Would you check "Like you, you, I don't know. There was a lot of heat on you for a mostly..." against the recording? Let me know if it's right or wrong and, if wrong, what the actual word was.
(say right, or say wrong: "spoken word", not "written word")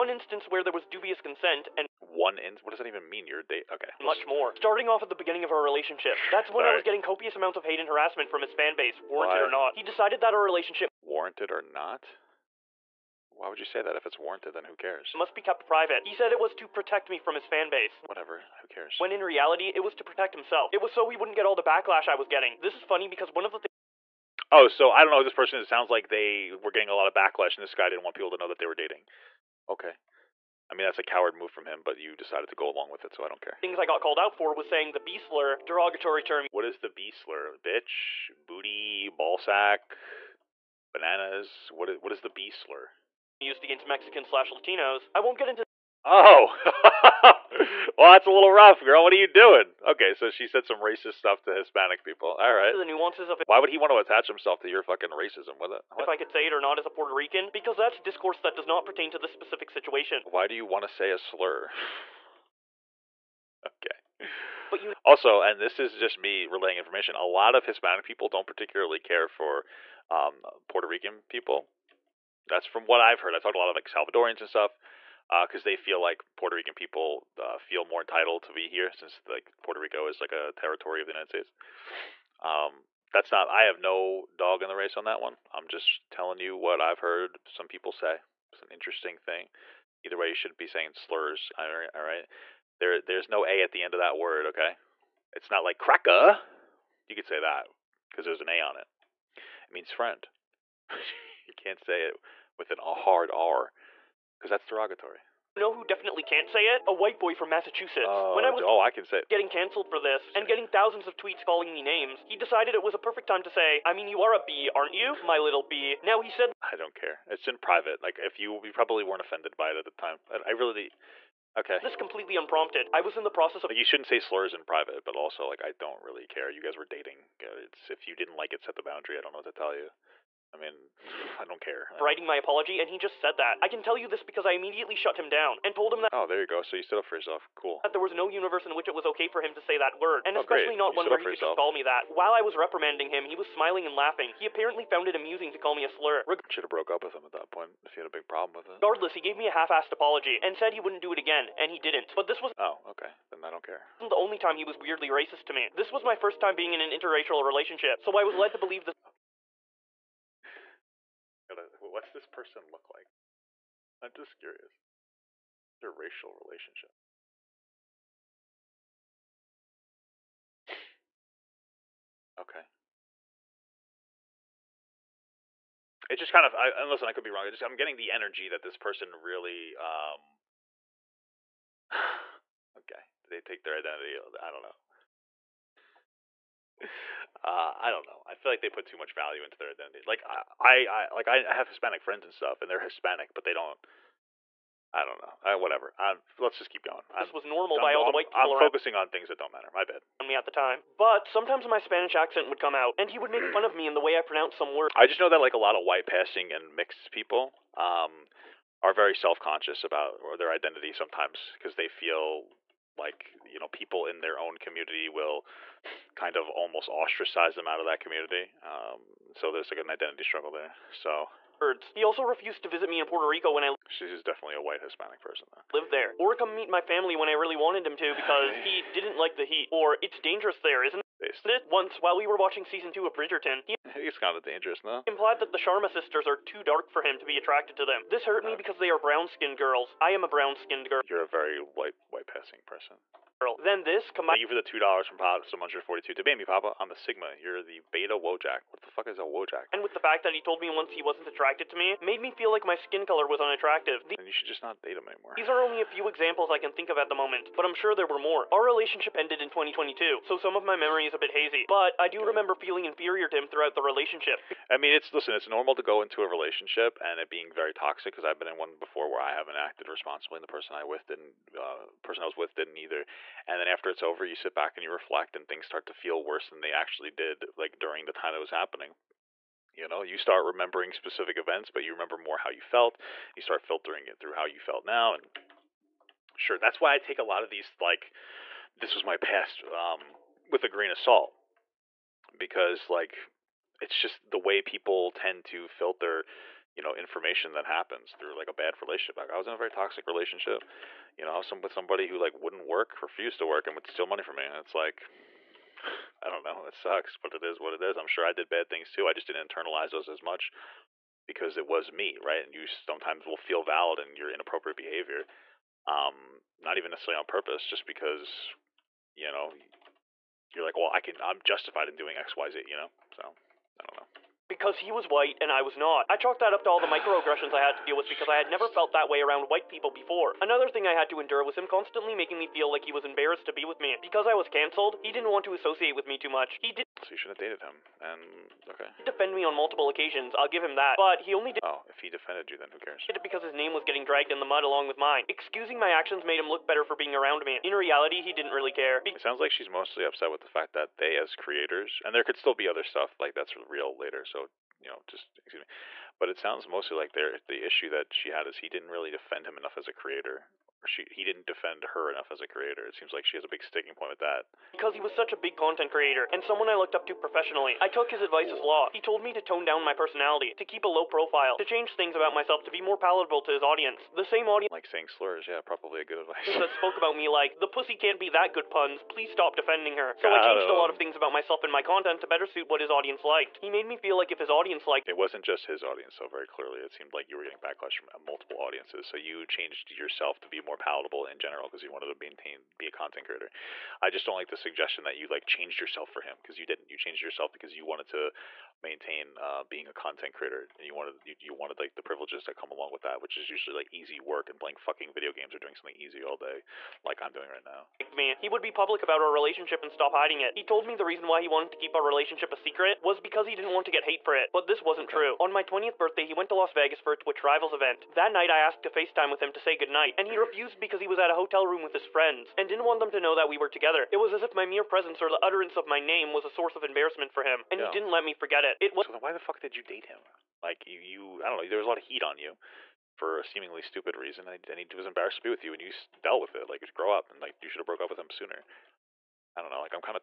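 wrong: "seemingly", not "mostly".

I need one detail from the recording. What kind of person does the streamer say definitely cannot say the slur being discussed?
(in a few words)
A white boy from Massachusetts.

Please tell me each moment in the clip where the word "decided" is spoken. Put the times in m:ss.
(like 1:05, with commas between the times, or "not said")
0:09, 0:32, 1:52.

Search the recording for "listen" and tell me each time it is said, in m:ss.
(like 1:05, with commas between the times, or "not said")
2:56, 4:25.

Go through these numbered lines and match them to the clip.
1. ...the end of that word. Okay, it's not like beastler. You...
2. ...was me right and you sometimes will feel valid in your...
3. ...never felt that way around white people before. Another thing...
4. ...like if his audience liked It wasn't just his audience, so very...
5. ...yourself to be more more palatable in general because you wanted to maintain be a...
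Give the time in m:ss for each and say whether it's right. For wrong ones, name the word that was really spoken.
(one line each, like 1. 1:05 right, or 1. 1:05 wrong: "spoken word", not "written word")
1. 1:33 wrong: "cracker", not "beastler"
2. 5:11 right
3. 5:28 right
4. 6:24 right
5. 6:29 right.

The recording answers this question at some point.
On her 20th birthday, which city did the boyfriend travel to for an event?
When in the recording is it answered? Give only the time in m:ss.
6:56.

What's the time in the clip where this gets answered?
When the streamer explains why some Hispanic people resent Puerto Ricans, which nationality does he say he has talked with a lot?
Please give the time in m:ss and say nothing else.
1:13.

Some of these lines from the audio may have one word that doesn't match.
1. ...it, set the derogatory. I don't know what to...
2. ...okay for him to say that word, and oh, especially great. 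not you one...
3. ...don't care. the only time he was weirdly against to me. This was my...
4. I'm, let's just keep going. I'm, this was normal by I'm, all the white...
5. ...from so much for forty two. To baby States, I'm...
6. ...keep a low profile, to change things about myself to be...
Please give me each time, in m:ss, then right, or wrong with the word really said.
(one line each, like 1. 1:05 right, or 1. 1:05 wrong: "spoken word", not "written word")
1. 2:08 wrong: "boundary", not "derogatory"
2. 2:19 right
3. 2:33 wrong: "racist", not "against"
4. 3:15 right
5. 4:05 wrong: "Papa", not "States"
6. 6:10 right.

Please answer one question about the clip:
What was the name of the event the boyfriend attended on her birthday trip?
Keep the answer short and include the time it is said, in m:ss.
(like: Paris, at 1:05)
Twitch Rivals, at 6:57.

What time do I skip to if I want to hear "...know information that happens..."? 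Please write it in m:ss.
4:56.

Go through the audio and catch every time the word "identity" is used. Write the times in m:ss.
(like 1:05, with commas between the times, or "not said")
3:03, 3:09, 3:30, 3:39.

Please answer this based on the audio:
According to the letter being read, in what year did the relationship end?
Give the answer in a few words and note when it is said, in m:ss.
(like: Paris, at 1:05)
2022, at 4:19.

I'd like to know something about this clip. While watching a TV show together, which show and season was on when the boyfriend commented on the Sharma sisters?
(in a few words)
Bridgerton season 2.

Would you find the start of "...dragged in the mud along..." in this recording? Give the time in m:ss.
5:44.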